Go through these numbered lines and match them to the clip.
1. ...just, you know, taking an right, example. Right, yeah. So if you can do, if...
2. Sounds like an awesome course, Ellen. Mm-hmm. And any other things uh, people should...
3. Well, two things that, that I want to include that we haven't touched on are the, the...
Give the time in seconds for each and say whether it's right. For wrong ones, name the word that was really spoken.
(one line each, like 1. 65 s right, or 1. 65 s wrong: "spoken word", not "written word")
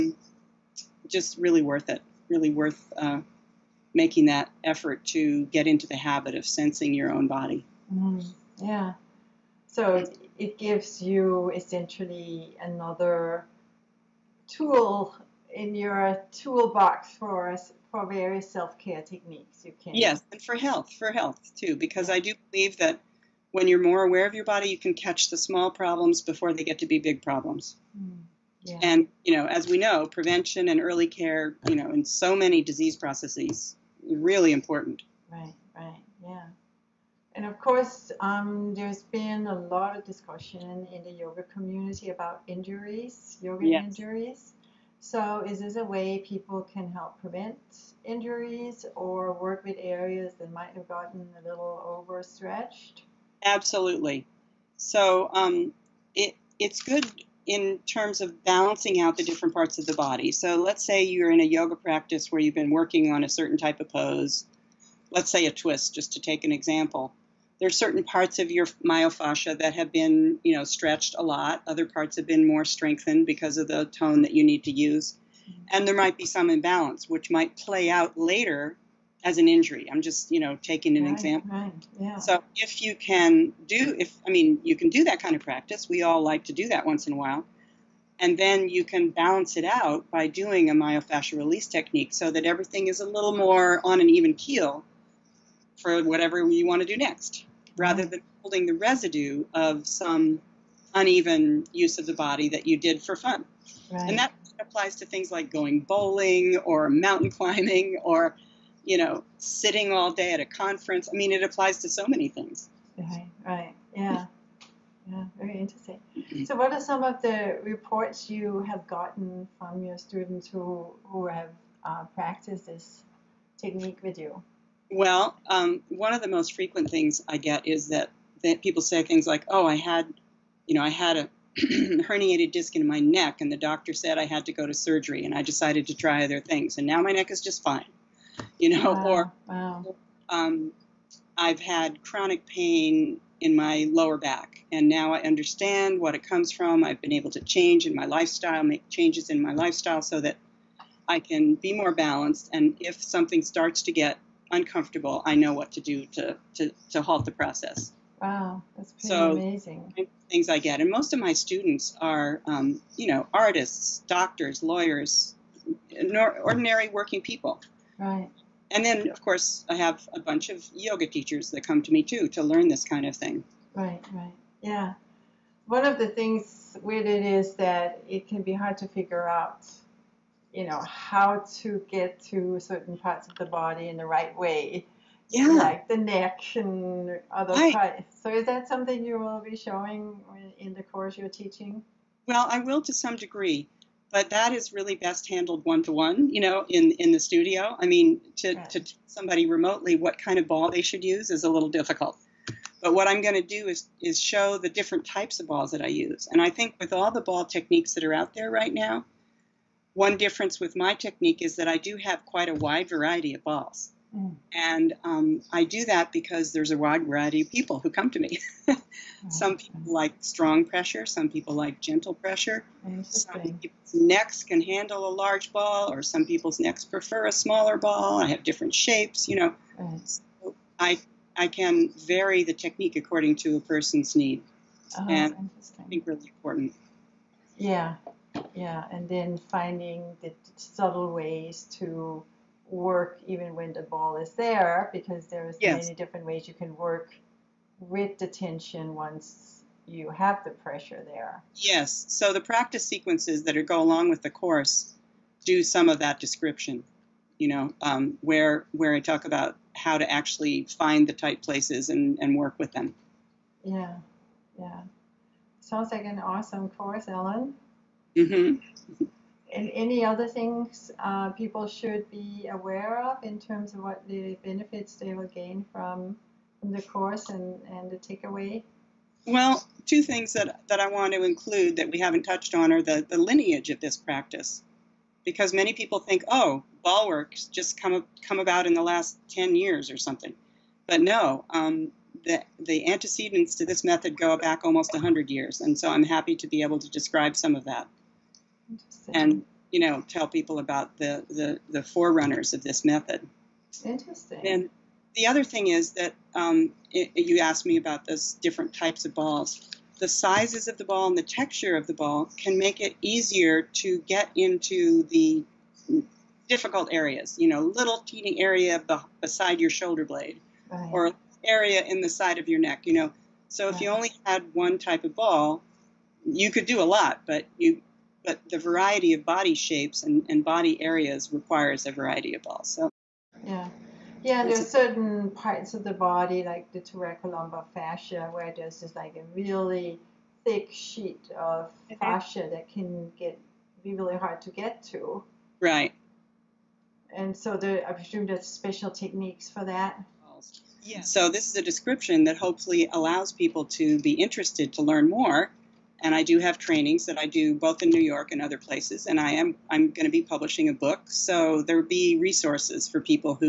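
1. 80 s right
2. 265 s right
3. 279 s right.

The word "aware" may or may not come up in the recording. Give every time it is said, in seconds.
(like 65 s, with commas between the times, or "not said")
24 s, 272 s.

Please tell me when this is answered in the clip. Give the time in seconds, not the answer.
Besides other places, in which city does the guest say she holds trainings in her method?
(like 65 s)
357 s.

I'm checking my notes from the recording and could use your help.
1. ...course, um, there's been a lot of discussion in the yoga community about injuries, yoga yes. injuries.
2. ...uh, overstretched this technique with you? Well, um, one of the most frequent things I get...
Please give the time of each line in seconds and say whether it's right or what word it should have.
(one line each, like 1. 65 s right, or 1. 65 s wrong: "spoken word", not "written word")
1. 37 s right
2. 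121 s wrong: "practiced", not "overstretched".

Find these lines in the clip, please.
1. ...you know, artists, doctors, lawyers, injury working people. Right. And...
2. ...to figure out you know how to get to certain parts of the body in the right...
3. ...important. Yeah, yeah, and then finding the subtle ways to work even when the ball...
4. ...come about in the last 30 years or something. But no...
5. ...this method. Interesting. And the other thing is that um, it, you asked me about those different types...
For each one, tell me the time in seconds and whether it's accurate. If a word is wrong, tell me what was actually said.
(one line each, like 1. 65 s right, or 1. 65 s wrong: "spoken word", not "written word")
1. 162 s wrong: "ordinary", not "injury"
2. 178 s right
3. 236 s right
4. 288 s wrong: "10", not "30"
5. 302 s right.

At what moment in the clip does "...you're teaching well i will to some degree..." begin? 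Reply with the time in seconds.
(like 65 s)
191 s.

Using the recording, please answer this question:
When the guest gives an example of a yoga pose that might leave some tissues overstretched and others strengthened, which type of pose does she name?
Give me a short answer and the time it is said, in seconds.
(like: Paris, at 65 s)
A twist, at 65 s.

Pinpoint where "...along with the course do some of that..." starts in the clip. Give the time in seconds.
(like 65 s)
253 s.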